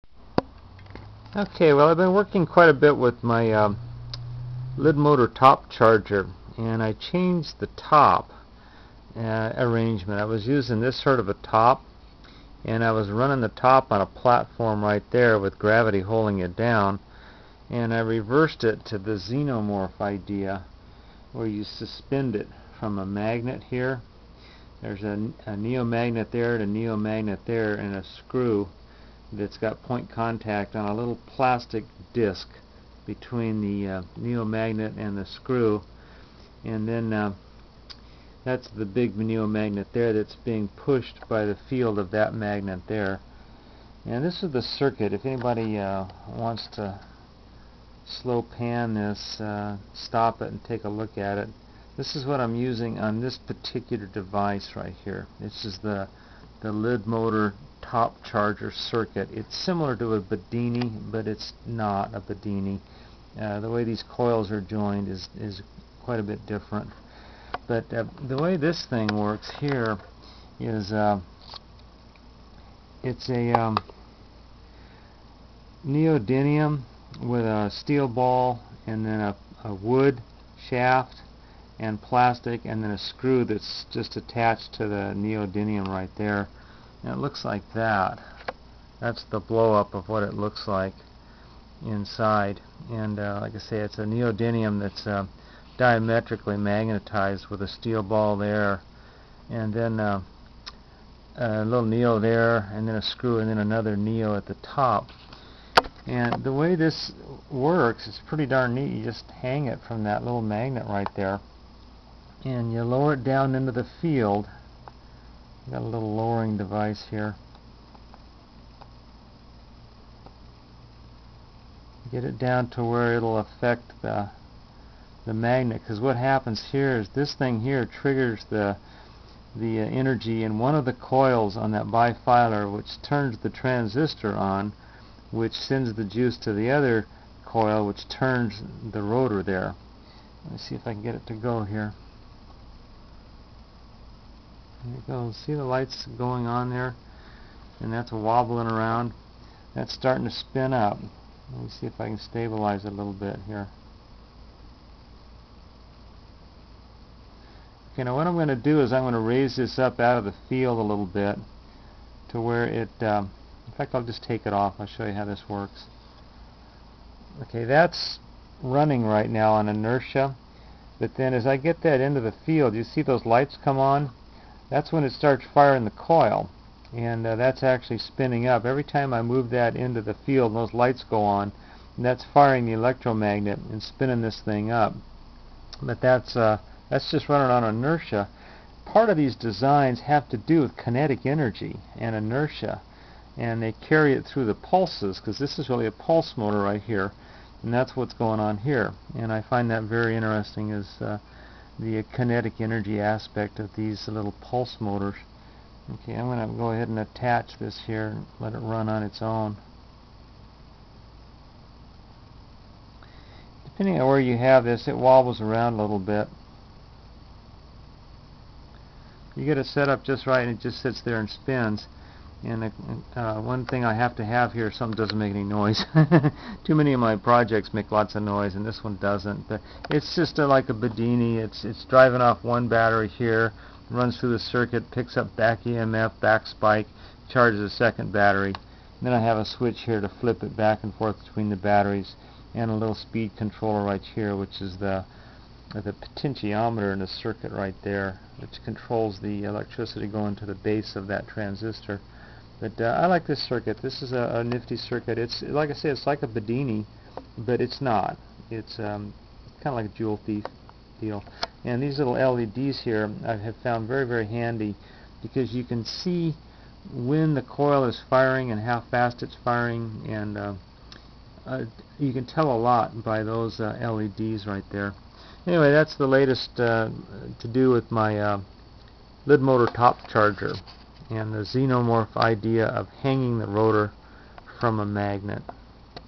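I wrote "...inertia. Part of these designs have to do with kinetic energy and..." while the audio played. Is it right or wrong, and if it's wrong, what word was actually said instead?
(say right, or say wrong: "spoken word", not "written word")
right.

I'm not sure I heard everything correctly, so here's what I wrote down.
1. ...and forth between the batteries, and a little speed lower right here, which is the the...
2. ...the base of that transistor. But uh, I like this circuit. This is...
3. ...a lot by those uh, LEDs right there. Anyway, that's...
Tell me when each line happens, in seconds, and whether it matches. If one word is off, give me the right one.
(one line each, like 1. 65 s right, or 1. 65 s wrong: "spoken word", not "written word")
1. 240 s wrong: "controller", not "lower"
2. 250 s right
3. 272 s right.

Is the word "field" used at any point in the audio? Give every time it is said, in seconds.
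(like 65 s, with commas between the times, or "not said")
41 s, 114 s, 160 s, 172 s, 180 s.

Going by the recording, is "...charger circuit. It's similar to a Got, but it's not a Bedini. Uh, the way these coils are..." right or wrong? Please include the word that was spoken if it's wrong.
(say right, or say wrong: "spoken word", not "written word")
wrong: "Bedini", not "Got".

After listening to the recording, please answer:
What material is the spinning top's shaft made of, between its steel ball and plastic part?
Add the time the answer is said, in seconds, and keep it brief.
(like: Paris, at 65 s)
wood, at 79 s.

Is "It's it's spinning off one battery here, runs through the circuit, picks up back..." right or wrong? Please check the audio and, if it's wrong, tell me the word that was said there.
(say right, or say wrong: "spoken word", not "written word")
wrong: "driving", not "spinning".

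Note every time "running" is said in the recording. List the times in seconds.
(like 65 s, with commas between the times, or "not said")
13 s, 168 s, 187 s.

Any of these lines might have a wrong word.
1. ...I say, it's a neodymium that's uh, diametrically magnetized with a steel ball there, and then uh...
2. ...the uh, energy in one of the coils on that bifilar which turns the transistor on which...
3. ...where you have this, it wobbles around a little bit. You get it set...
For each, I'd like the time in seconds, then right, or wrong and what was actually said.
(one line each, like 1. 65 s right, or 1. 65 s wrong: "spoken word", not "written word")
1. 93 s right
2. 129 s right
3. 214 s right.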